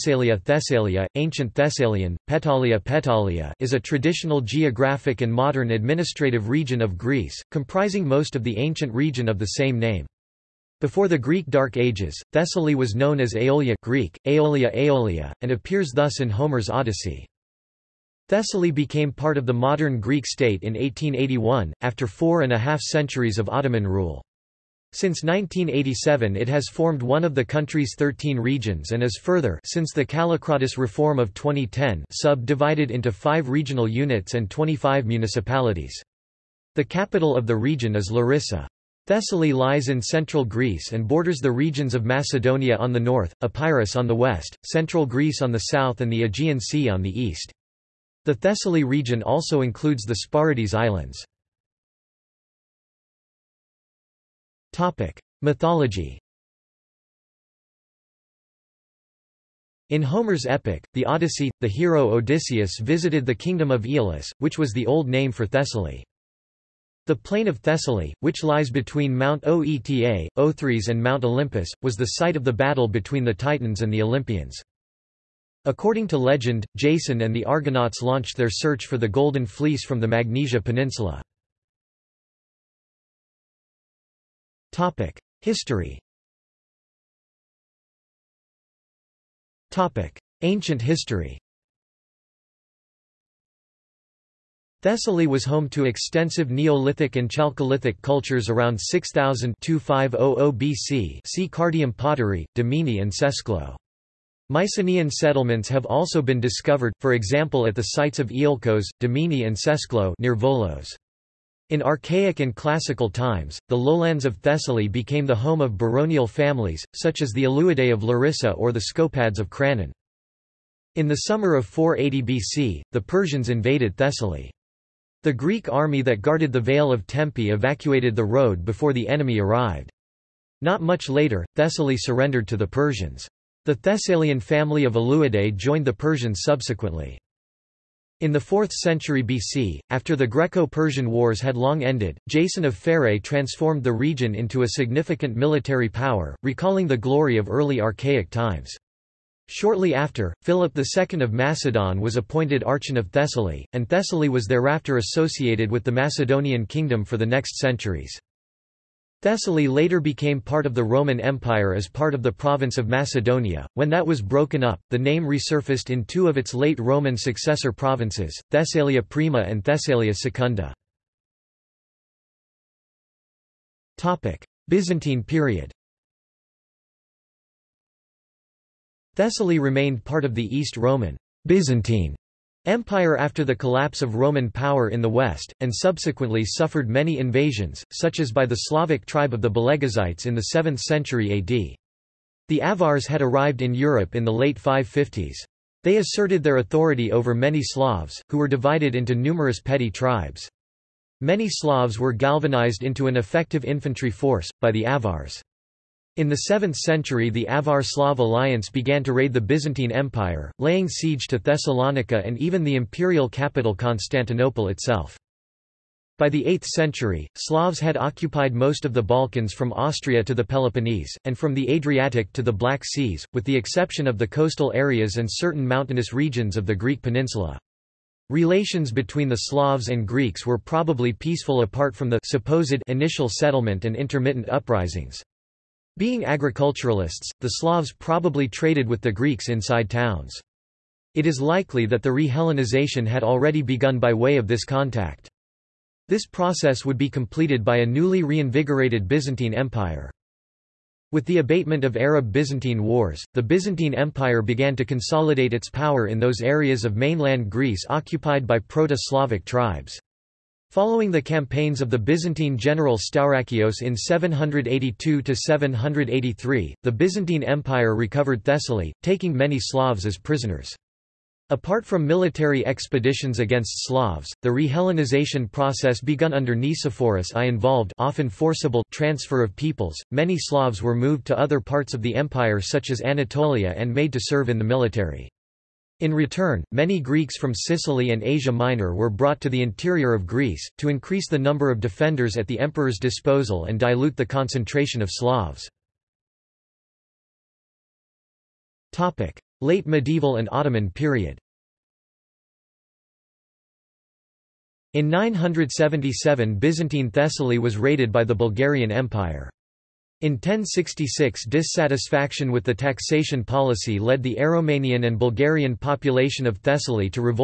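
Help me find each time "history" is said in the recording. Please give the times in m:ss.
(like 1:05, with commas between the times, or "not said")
1:25, 1:30.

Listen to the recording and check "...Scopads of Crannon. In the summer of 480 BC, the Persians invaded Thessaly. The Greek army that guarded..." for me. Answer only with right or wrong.
right.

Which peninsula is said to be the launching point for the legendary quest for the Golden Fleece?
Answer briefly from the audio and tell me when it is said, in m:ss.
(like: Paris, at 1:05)
Magnesia Peninsula, at 1:20.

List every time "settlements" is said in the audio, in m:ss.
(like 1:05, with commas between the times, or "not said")
1:45, 3:53.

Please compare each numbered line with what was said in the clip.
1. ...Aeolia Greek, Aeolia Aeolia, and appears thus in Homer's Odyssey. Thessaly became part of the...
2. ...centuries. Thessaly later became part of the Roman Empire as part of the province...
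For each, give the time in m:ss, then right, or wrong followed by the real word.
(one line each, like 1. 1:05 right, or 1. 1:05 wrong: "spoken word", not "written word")
1. 0:13 right
2. 2:37 right.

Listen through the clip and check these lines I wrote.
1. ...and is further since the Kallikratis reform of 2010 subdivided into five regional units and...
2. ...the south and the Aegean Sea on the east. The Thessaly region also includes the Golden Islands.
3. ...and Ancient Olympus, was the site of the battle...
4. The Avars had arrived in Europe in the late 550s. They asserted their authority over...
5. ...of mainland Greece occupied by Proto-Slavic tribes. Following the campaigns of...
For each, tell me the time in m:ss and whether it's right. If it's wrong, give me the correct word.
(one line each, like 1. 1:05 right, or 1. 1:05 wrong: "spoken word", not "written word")
1. 0:28 right
2. 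0:45 wrong: "Sporades", not "Golden"
3. 1:10 wrong: "Mount", not "Ancient"
4. 3:12 right
5. 4:16 right.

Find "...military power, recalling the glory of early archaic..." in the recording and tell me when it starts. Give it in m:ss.
2:25.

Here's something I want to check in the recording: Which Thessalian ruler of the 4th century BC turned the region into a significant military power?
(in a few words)
Jason of Pharae.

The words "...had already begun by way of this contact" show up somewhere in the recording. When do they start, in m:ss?
4:03.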